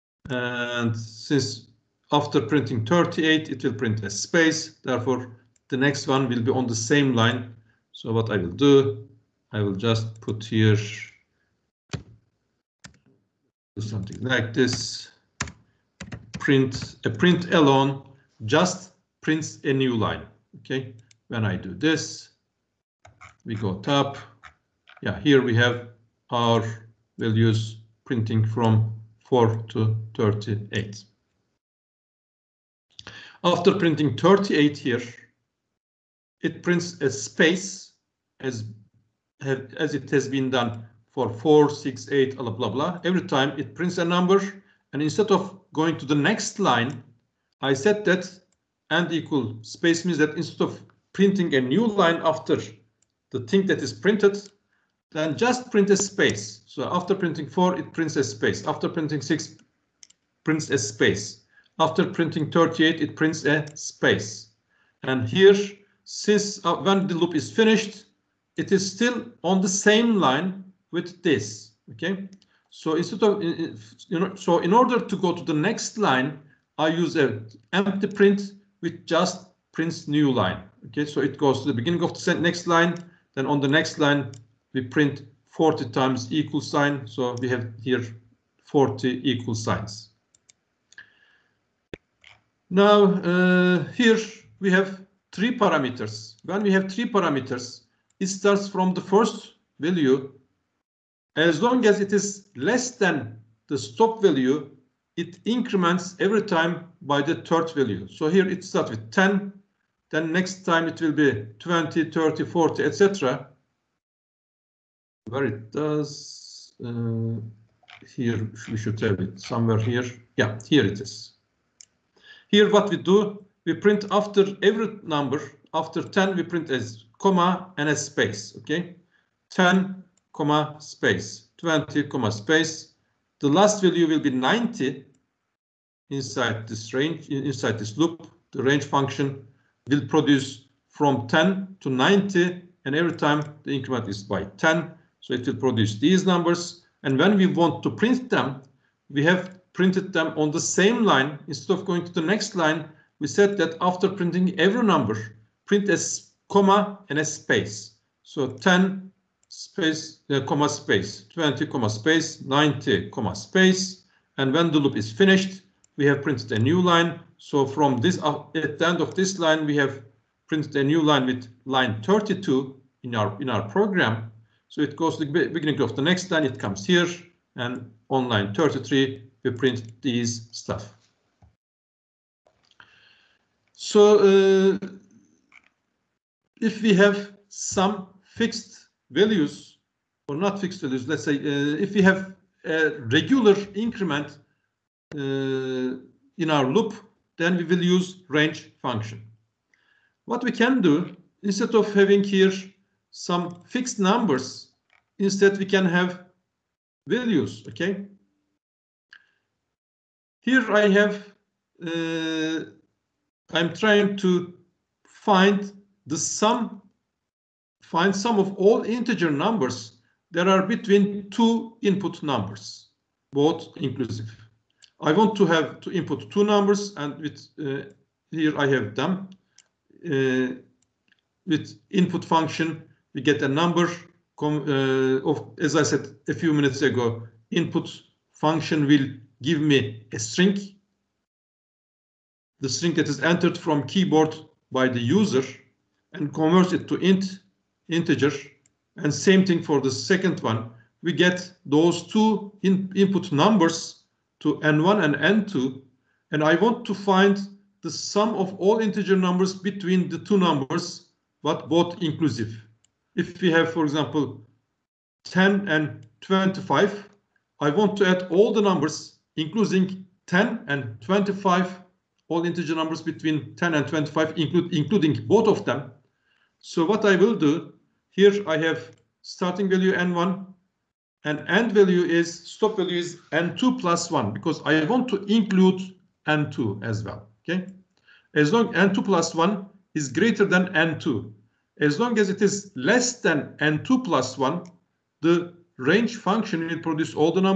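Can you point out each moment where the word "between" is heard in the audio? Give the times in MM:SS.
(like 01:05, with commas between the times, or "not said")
03:40, 04:19, 04:33.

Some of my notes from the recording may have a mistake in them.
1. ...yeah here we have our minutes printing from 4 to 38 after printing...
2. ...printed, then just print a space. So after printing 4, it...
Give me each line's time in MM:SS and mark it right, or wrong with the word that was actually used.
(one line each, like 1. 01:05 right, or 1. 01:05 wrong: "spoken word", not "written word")
1. 00:25 wrong: "values", not "minutes"
2. 00:53 right.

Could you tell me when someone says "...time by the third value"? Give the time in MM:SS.
01:46.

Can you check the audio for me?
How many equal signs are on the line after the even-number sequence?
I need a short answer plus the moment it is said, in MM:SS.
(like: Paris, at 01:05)
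40, at 01:28.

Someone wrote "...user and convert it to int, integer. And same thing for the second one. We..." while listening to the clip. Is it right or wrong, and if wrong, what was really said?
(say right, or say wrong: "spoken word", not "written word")
right.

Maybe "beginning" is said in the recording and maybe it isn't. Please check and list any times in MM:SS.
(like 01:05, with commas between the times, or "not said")
01:21, 02:55.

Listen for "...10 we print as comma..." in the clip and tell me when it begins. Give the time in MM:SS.
02:06.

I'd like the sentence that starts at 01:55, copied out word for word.
Where it does, uh, here we should have it somewhere here.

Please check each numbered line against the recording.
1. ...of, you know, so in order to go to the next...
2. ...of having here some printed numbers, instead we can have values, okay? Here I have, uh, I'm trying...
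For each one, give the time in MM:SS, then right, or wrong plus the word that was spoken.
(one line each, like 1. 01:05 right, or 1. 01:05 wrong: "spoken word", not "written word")
1. 01:13 right
2. 03:21 wrong: "fixed", not "printed".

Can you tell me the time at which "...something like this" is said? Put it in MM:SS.
00:13.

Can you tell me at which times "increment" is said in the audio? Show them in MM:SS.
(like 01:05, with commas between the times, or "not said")
01:45, 02:23, 03:13.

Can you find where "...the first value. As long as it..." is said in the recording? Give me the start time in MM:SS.
01:38.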